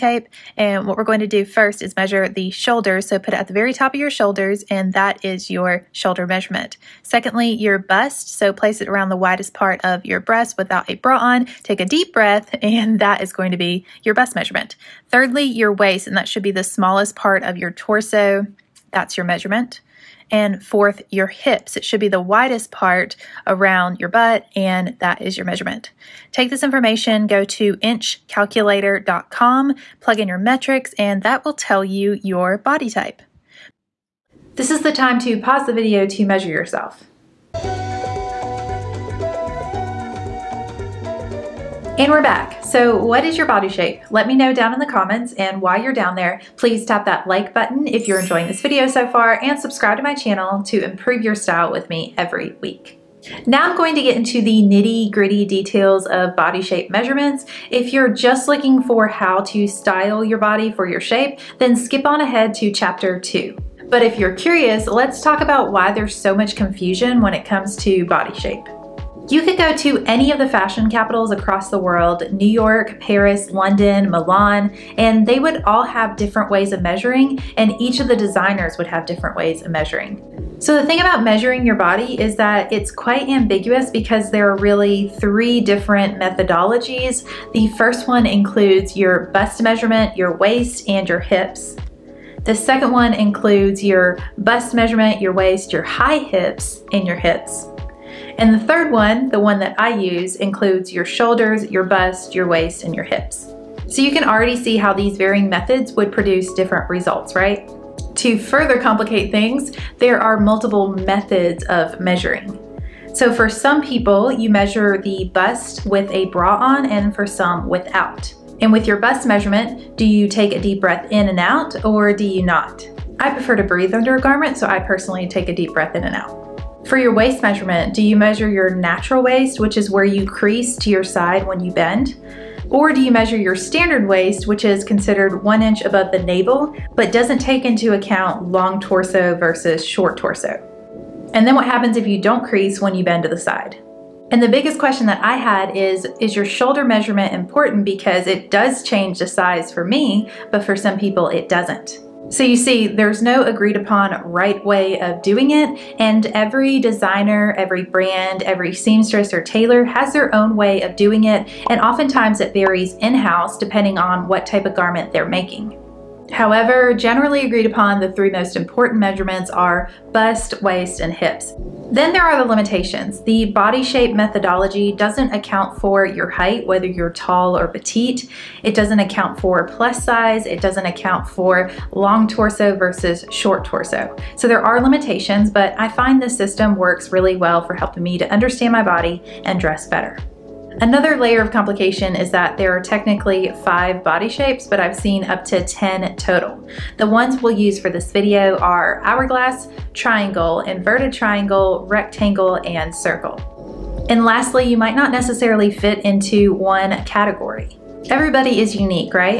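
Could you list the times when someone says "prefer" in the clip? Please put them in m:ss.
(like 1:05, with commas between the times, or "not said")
2:03.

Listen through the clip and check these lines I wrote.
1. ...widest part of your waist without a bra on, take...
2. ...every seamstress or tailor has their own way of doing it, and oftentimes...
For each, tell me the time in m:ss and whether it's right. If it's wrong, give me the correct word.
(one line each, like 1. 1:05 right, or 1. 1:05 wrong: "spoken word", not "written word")
1. 0:09 wrong: "breast", not "waist"
2. 2:38 right.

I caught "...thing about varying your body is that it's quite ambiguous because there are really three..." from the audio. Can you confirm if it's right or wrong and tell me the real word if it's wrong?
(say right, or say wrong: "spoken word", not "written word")
wrong: "measuring", not "varying".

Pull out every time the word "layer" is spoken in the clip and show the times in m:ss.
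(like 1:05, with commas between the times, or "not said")
3:11.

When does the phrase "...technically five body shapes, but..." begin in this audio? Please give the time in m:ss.
3:12.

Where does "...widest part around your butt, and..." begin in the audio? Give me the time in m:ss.
0:22.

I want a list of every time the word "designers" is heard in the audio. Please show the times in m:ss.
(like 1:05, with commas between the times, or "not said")
1:18, 2:36.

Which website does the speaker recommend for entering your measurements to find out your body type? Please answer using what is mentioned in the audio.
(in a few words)
inchcalculator.com.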